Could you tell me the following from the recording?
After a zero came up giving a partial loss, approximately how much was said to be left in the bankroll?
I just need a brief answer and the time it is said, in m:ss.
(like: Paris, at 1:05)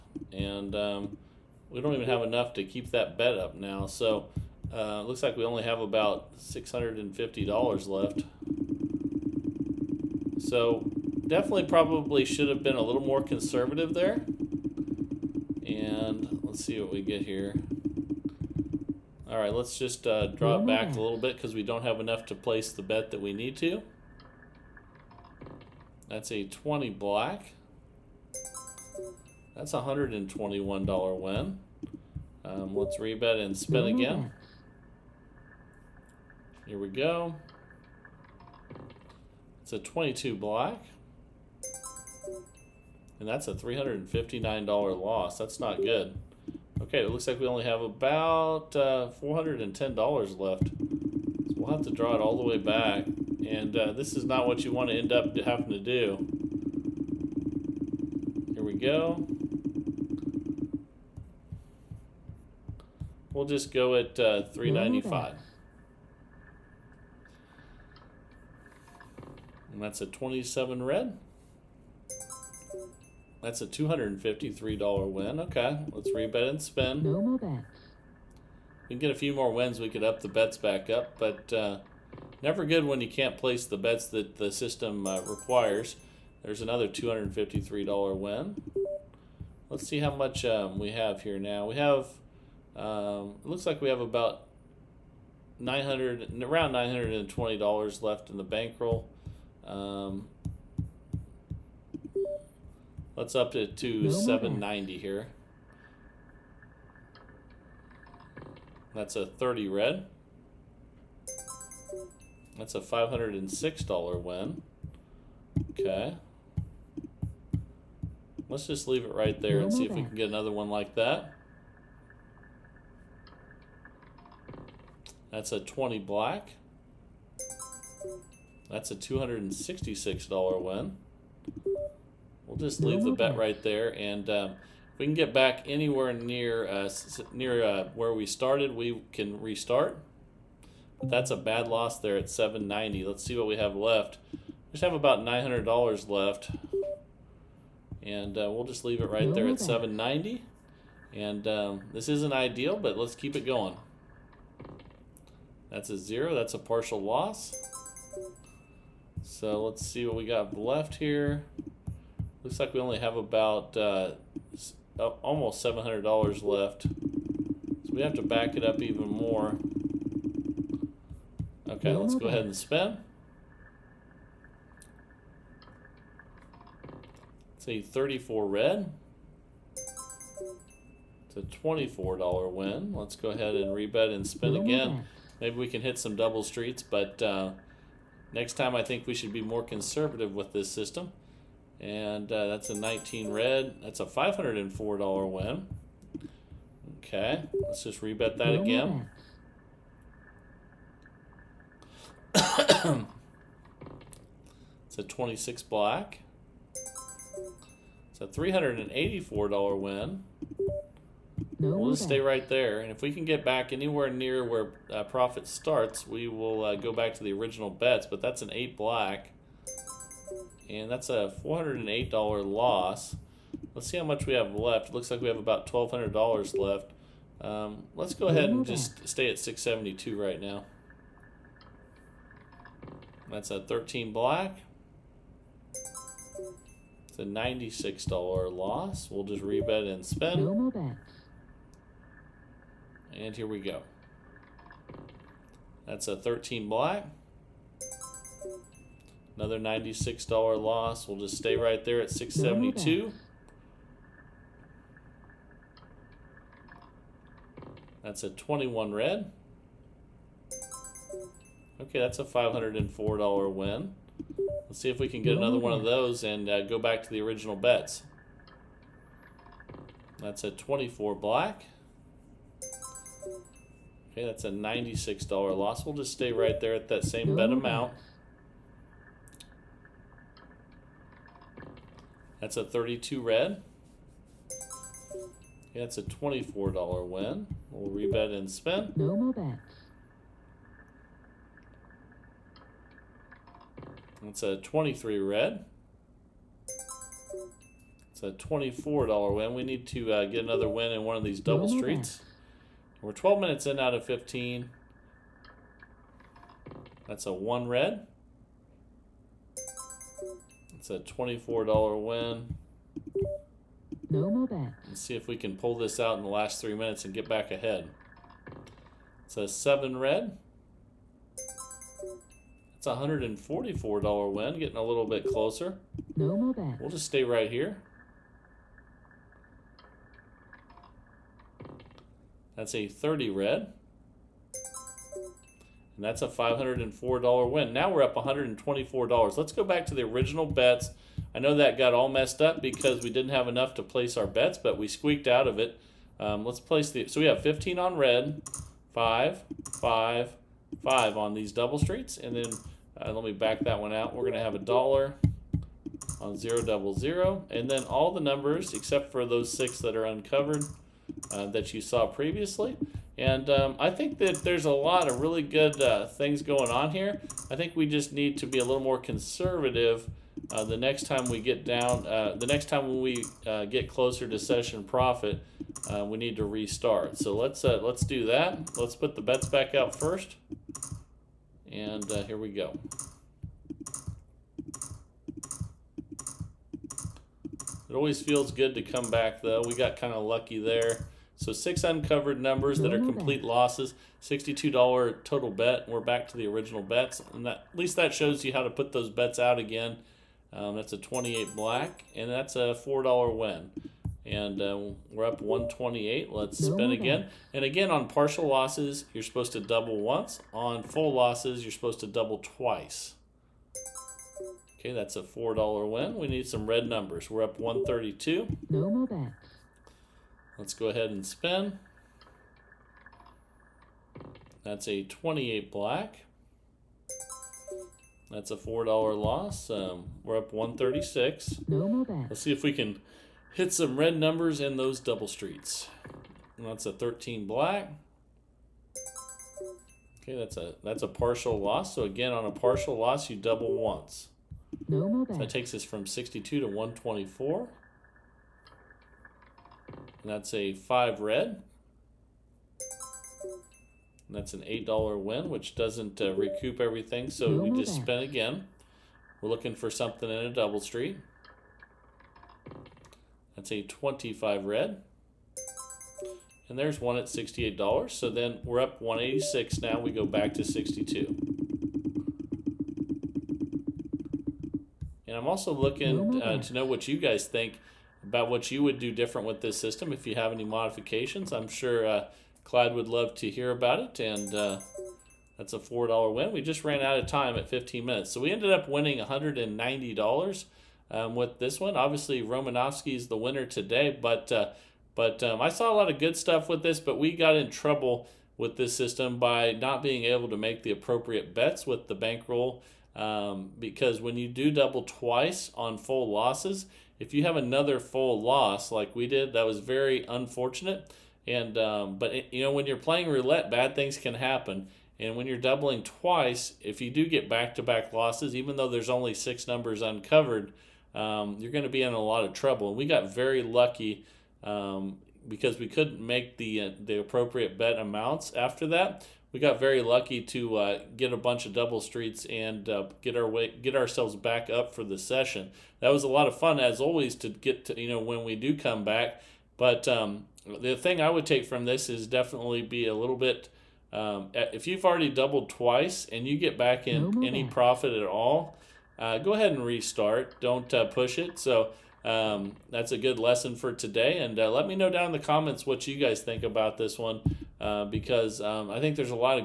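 almost $700, at 2:45.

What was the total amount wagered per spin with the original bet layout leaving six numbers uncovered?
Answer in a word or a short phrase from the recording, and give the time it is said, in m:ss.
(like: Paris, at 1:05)
$62, at 6:34.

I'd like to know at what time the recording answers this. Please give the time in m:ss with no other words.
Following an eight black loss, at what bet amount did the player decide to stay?
3:49.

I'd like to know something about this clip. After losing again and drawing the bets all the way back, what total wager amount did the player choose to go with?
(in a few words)
395.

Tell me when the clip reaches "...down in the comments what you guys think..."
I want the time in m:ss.
9:15.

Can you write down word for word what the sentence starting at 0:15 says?
And let's see what we get here.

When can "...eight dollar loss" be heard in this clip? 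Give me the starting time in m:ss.
3:41.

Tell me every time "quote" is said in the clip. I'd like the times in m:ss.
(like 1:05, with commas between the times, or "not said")
not said.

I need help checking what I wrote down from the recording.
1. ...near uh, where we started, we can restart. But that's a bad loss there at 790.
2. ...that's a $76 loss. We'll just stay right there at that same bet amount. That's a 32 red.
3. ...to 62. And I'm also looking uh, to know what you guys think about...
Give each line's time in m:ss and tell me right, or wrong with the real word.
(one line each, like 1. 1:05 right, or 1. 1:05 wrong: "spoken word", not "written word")
1. 2:17 right
2. 4:34 wrong: "96", not "76"
3. 7:50 right.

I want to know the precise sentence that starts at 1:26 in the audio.
There's another two hundred and fifty three dollar win.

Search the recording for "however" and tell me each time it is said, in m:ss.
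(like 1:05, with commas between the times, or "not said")
not said.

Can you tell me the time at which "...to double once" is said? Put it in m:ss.
6:49.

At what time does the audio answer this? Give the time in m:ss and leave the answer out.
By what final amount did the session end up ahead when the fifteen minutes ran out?
8:09.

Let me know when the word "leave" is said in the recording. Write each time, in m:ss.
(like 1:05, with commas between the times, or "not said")
1:58, 2:12, 2:28.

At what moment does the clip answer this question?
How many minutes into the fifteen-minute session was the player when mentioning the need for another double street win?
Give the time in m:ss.
5:03.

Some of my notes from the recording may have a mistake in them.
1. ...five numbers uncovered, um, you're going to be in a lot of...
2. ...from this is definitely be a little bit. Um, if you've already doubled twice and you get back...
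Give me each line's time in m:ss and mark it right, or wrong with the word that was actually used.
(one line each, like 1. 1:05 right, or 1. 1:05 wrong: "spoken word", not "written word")
1. 8:39 wrong: "six", not "five"
2. 9:01 right.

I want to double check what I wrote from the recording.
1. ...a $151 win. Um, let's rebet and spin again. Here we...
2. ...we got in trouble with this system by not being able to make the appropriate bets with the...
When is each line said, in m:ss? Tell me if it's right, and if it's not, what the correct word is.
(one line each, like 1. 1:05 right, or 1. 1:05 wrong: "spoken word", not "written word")
1. 0:29 wrong: "121", not "151"
2. 8:17 right.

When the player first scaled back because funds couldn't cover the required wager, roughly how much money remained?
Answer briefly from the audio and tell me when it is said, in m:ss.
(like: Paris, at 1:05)
$650, at 0:06.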